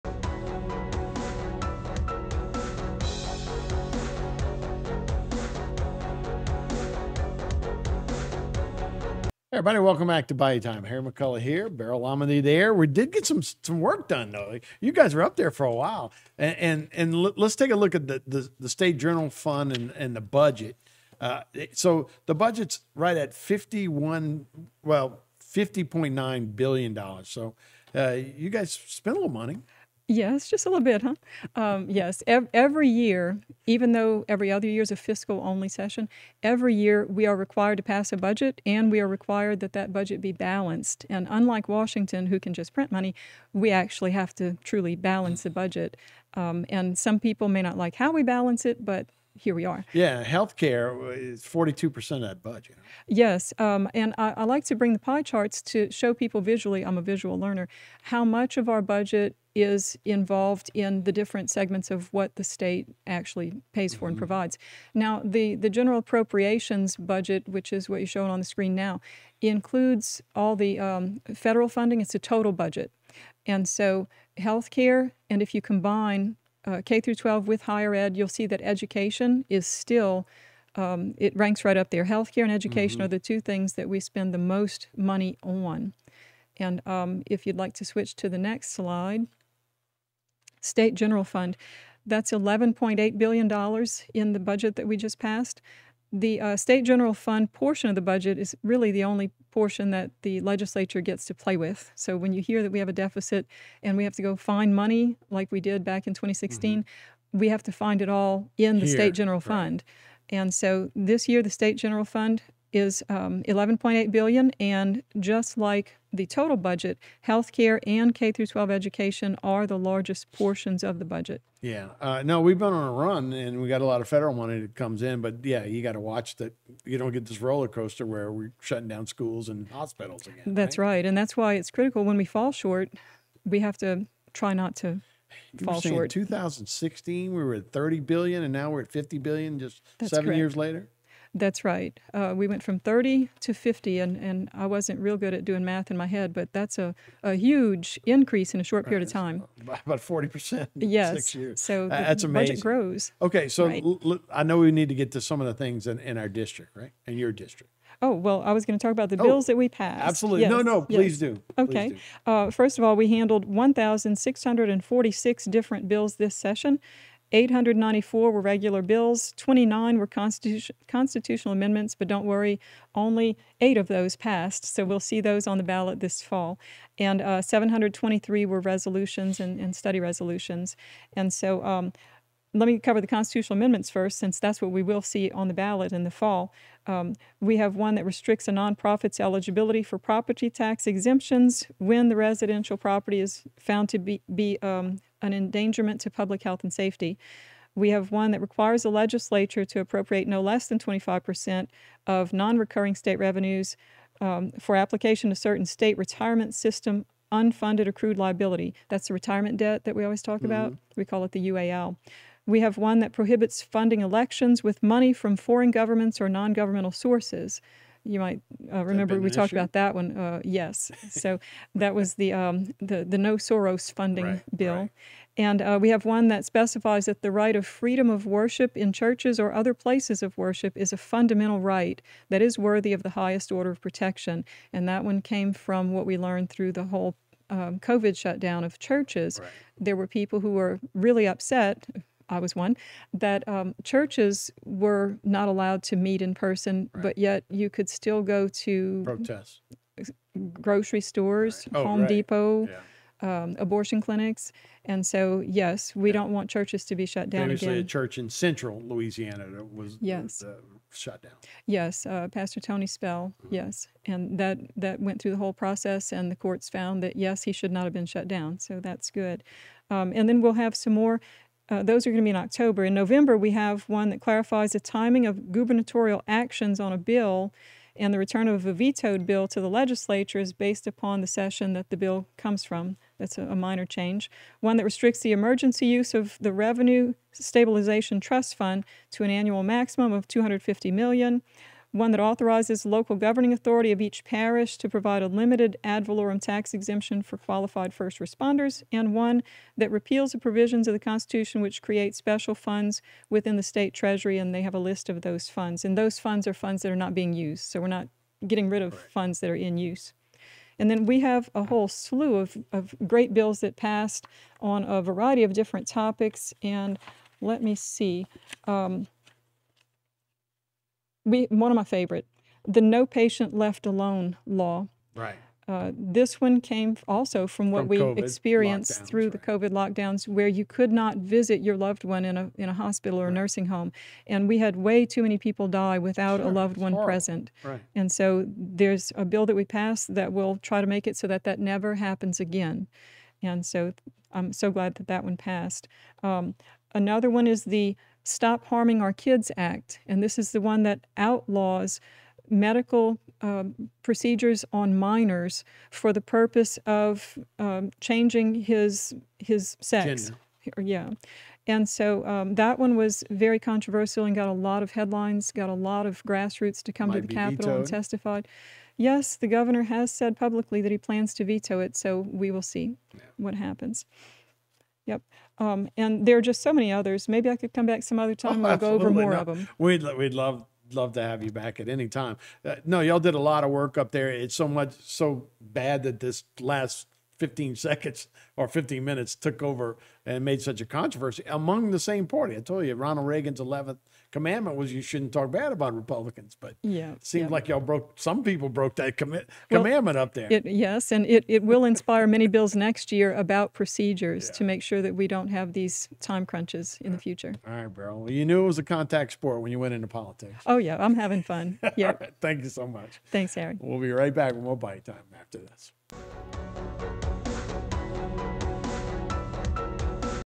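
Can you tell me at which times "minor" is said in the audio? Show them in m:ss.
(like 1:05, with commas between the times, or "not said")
4:43, 5:54.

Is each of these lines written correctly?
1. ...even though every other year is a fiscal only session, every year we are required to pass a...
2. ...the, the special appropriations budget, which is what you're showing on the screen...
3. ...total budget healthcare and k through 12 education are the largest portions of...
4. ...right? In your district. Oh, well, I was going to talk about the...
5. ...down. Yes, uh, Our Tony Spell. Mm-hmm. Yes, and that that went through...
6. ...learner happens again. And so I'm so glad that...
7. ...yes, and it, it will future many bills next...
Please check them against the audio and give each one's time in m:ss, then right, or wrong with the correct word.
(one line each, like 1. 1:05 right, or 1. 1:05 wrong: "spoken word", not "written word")
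1. 0:33 right
2. 1:05 wrong: "general", not "special"
3. 1:56 right
4. 2:36 right
5. 4:21 wrong: "Pastor", not "Our"
6. 5:41 wrong: "never", not "learner"
7. 6:40 wrong: "inspire", not "future".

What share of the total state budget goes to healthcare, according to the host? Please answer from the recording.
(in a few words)
42%.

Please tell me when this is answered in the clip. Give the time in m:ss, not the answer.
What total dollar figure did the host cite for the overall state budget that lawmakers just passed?
0:25.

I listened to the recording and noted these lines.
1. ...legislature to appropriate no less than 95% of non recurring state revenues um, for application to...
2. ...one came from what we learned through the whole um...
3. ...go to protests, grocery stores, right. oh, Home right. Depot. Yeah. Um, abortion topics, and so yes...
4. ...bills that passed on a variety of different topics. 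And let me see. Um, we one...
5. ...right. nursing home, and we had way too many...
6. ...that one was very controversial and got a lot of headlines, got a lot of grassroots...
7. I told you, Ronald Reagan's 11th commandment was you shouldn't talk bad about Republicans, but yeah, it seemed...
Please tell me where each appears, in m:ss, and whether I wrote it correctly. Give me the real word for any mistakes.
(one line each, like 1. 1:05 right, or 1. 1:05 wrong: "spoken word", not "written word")
1. 3:18 wrong: "25", not "95"
2. 3:55 right
3. 4:08 wrong: "clinics", not "topics"
4. 5:13 right
5. 5:33 right
6. 6:02 right
7. 6:32 right.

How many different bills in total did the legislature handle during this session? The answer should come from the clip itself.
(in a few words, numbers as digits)
1,646.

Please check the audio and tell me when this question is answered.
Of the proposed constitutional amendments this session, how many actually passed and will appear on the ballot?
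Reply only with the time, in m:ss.
2:53.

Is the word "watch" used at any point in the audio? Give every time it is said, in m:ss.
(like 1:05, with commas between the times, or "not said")
2:05.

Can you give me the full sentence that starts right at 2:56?
And uh, 723 were resolutions and, and, study resolutions.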